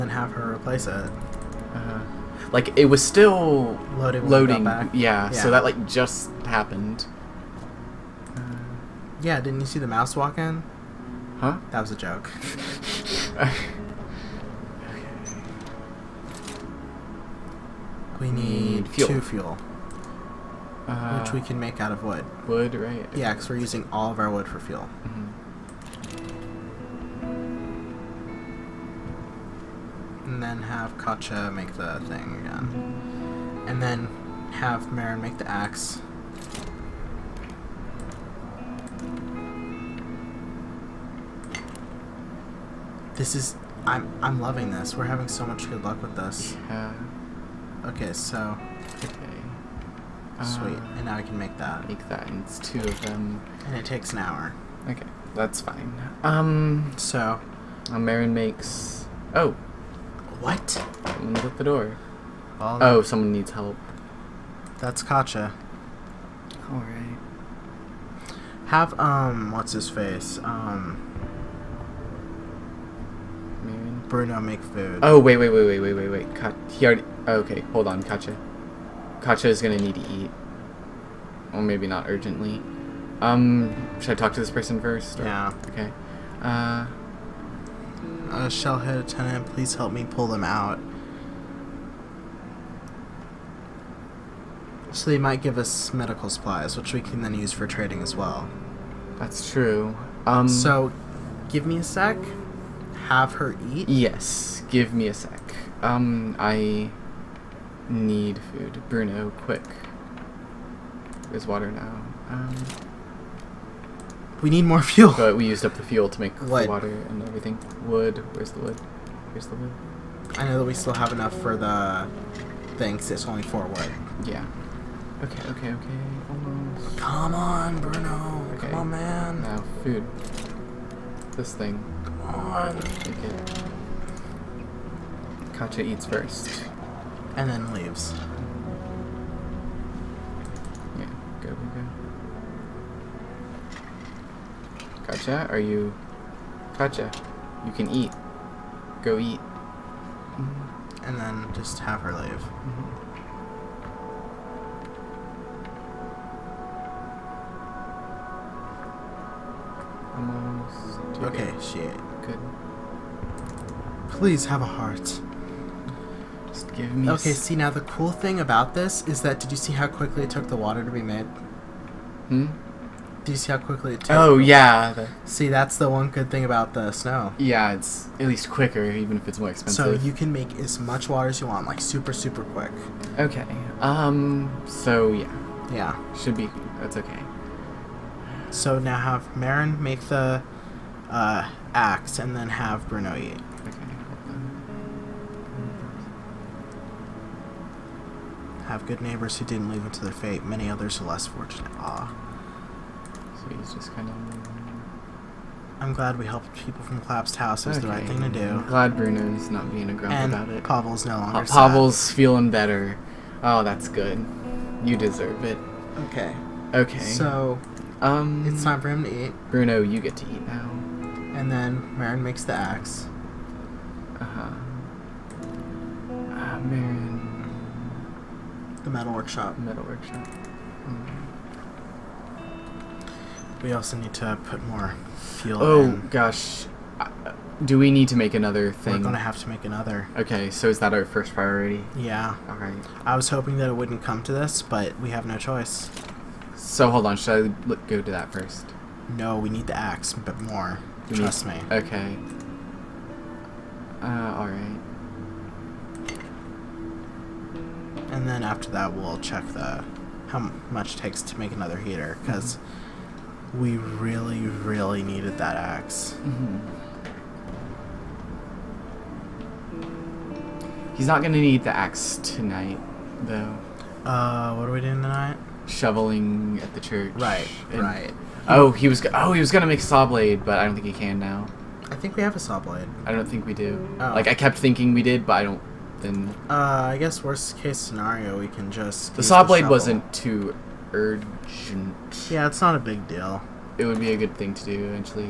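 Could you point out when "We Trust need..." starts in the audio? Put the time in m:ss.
4:11.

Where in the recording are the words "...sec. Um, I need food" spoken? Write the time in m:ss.
1:45.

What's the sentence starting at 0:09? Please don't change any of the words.
Yeah, didn't you see the mouse walk in?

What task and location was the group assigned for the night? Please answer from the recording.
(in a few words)
Shoveling at the church.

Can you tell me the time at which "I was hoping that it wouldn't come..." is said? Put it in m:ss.
4:03.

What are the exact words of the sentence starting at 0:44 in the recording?
We're having so much good luck with this.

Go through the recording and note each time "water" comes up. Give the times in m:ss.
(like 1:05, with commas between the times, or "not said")
1:51, 1:56, 2:50, 3:01.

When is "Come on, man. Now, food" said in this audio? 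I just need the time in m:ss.
2:08.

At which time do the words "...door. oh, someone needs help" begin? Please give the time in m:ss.
1:01.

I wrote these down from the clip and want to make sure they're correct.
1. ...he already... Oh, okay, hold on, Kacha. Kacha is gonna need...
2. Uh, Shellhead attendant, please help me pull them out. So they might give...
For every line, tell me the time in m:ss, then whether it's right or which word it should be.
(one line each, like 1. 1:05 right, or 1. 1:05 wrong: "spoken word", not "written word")
1. 1:16 right
2. 1:28 right.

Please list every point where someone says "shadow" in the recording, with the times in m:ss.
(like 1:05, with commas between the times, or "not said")
not said.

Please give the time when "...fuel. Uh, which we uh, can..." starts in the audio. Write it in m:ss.
0:19.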